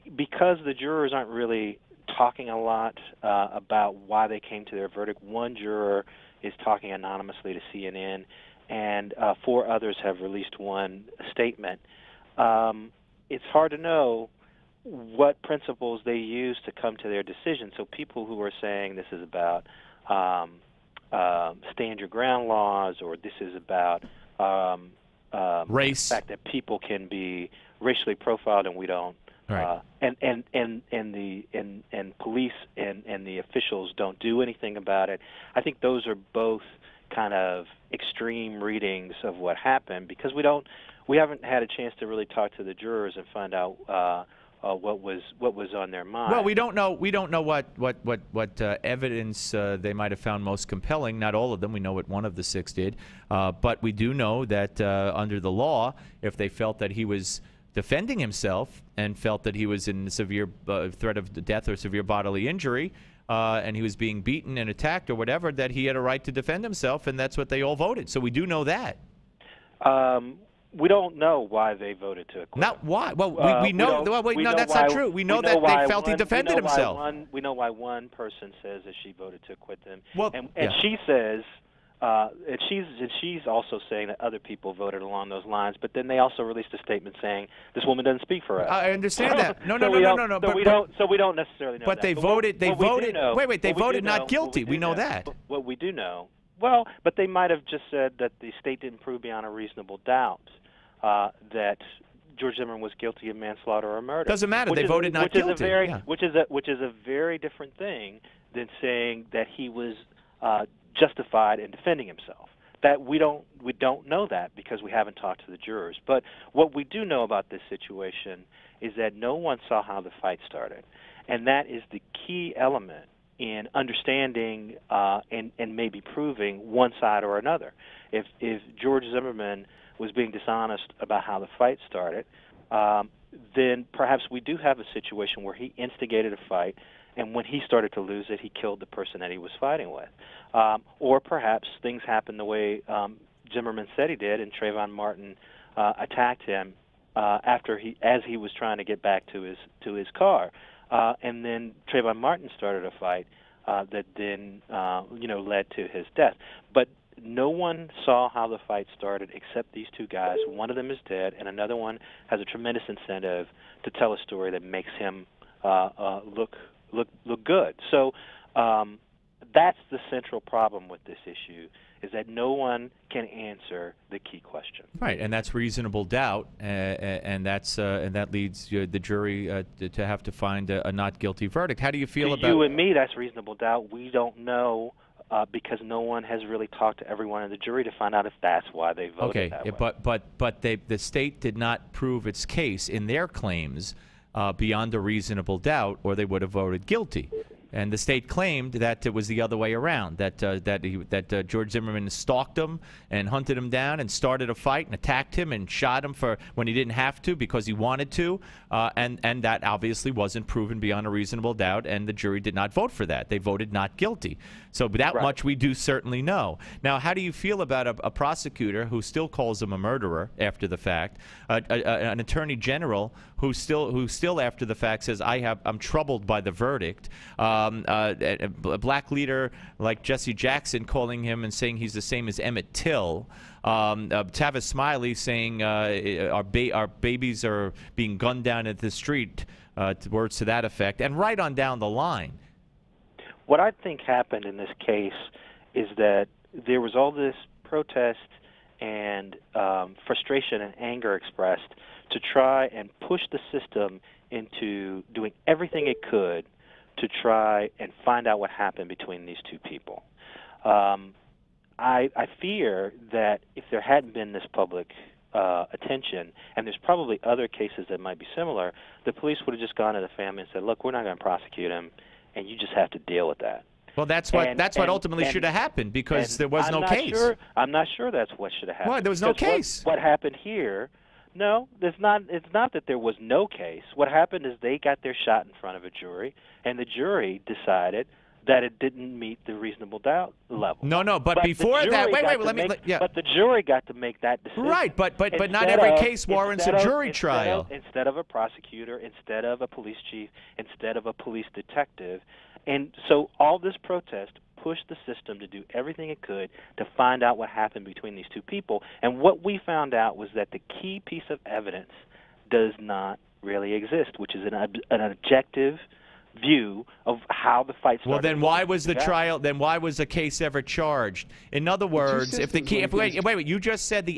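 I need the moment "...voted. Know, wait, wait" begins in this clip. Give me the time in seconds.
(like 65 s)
92 s.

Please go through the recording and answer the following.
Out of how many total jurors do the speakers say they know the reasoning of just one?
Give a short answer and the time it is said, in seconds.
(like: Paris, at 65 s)
6, at 52 s.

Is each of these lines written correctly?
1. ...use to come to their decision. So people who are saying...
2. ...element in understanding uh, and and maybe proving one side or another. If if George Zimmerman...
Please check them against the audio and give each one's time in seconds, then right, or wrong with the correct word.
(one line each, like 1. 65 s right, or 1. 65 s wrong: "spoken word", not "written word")
1. 16 s right
2. 122 s right.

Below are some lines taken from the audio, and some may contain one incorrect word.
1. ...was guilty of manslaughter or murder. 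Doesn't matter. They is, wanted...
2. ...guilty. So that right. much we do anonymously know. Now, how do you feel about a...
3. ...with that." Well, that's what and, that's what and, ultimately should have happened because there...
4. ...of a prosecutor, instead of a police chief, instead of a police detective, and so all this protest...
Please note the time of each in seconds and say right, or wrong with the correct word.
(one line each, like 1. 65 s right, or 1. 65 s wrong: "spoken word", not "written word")
1. 102 s wrong: "voted", not "wanted"
2. 213 s wrong: "certainly", not "anonymously"
3. 273 s right
4. 298 s right.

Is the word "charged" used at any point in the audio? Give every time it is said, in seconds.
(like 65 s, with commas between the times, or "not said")
320 s.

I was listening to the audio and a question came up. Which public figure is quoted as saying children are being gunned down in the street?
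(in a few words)
Tavis Smiley.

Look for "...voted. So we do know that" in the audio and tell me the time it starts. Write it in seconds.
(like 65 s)
67 s.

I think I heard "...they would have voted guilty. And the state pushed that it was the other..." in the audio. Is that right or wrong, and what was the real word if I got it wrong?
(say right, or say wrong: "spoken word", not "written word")
wrong: "claimed", not "pushed".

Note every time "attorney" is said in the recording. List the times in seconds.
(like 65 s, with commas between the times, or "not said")
222 s.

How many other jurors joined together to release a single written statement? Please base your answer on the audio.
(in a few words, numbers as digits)
4.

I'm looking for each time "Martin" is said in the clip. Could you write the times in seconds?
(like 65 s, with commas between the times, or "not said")
144 s, 152 s.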